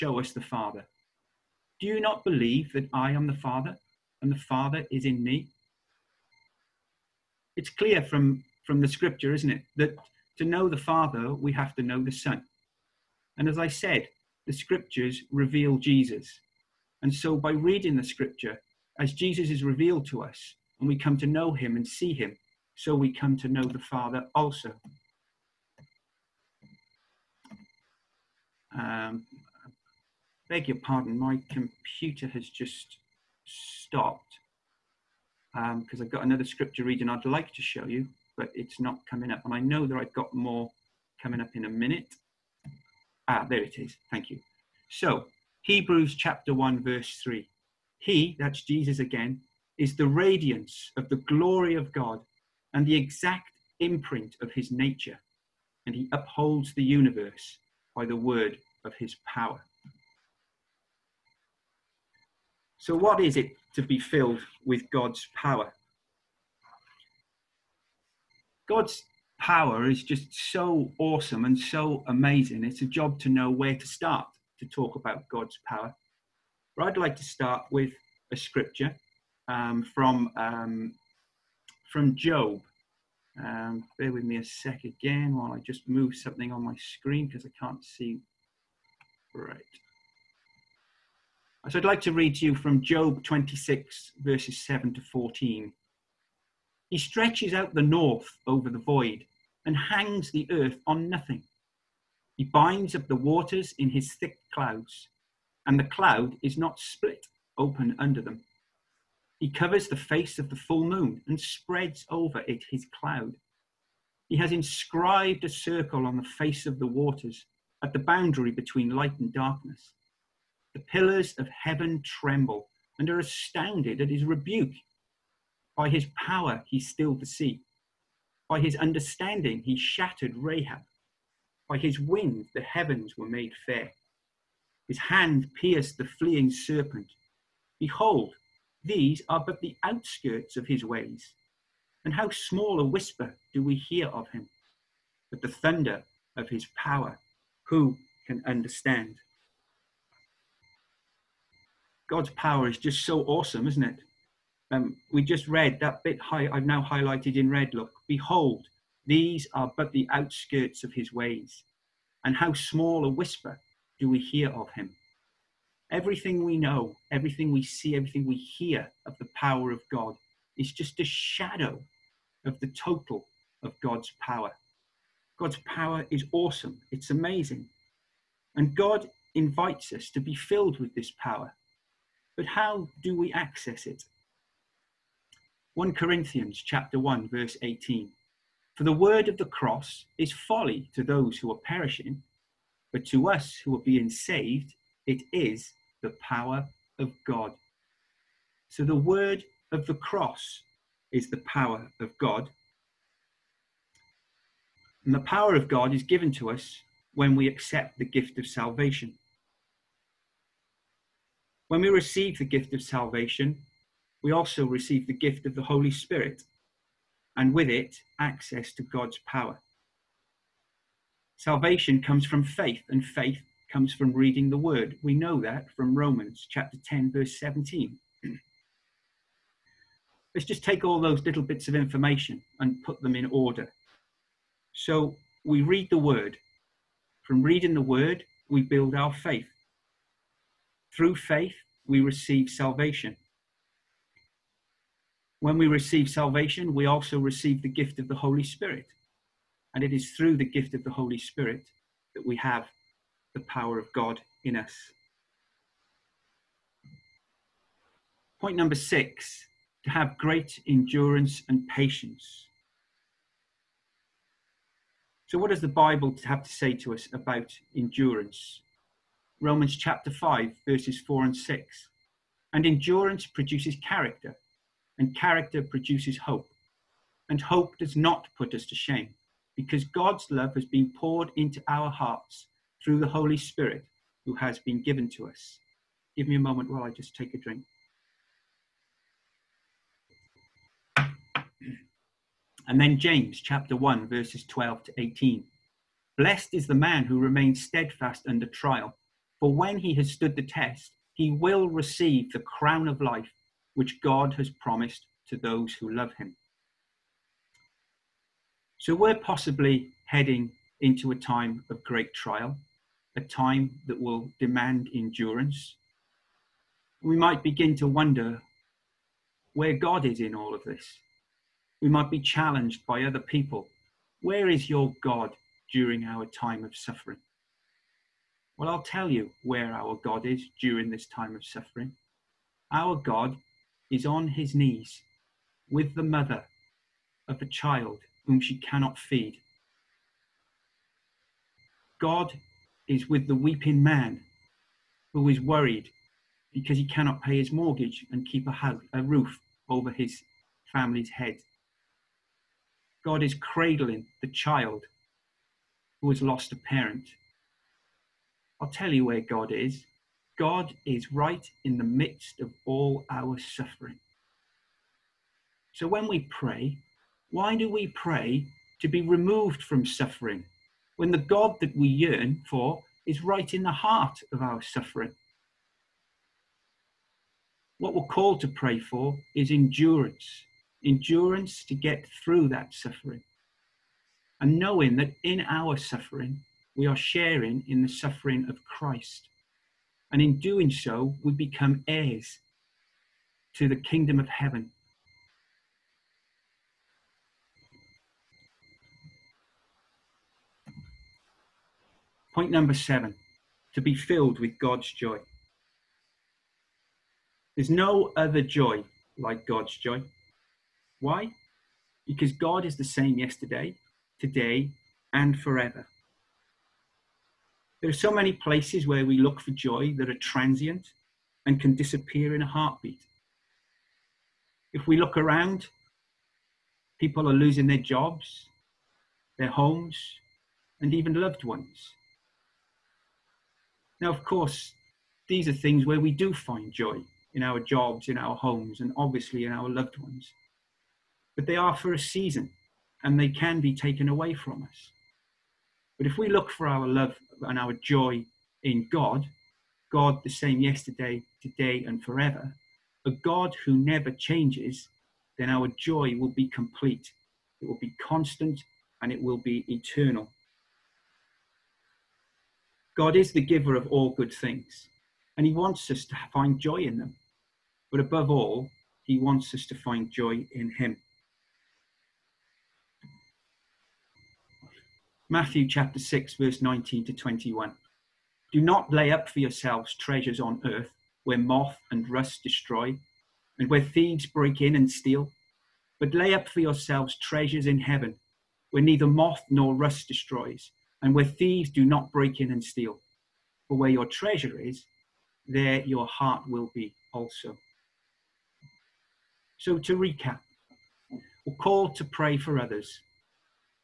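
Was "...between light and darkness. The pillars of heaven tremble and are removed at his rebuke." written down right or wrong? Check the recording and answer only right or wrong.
wrong.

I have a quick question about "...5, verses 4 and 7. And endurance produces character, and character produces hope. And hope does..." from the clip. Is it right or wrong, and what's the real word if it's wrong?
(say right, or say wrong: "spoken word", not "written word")
wrong: "6", not "7".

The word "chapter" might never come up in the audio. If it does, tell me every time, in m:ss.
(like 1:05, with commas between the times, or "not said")
0:46, 3:06, 3:46, 4:29, 4:53, 7:55.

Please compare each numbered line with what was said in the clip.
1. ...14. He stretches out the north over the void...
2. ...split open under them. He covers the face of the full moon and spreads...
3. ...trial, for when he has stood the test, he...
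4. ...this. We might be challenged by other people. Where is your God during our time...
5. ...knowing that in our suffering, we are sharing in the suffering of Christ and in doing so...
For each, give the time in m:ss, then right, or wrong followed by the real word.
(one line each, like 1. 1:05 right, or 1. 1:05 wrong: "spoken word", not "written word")
1. 1:35 right
2. 1:46 right
3. 4:58 right
4. 5:20 right
5. 6:24 right.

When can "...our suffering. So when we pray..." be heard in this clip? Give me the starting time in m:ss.
6:03.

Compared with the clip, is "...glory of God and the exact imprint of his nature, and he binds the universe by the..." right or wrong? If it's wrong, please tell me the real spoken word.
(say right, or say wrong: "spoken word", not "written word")
wrong: "upholds", not "binds".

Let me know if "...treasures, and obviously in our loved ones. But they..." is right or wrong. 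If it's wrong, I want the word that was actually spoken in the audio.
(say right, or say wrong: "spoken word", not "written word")
wrong: "homes", not "treasures".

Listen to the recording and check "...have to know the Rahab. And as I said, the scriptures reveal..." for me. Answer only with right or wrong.
wrong.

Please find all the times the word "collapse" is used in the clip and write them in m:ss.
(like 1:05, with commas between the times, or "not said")
not said.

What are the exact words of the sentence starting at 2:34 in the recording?
um, we just read that bit high, I've now highlighted in red.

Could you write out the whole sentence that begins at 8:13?
For where your treasure is, there your heart will be also.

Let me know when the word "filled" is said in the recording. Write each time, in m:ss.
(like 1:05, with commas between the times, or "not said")
1:03, 3:00, 6:43.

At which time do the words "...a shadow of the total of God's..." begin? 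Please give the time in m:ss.
2:50.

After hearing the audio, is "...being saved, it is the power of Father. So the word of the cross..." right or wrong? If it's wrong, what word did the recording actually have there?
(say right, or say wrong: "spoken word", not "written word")
wrong: "God", not "Father".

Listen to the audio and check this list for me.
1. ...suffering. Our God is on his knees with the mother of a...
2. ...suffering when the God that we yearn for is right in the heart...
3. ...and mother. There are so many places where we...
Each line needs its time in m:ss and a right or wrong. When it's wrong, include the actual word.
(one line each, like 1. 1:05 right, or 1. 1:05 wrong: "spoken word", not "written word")
1. 5:31 right
2. 6:09 right
3. 6:55 wrong: "forever", not "mother".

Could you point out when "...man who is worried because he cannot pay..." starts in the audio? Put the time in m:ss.
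5:43.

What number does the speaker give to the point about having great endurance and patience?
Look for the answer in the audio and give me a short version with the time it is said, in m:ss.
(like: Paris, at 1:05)
6, at 4:18.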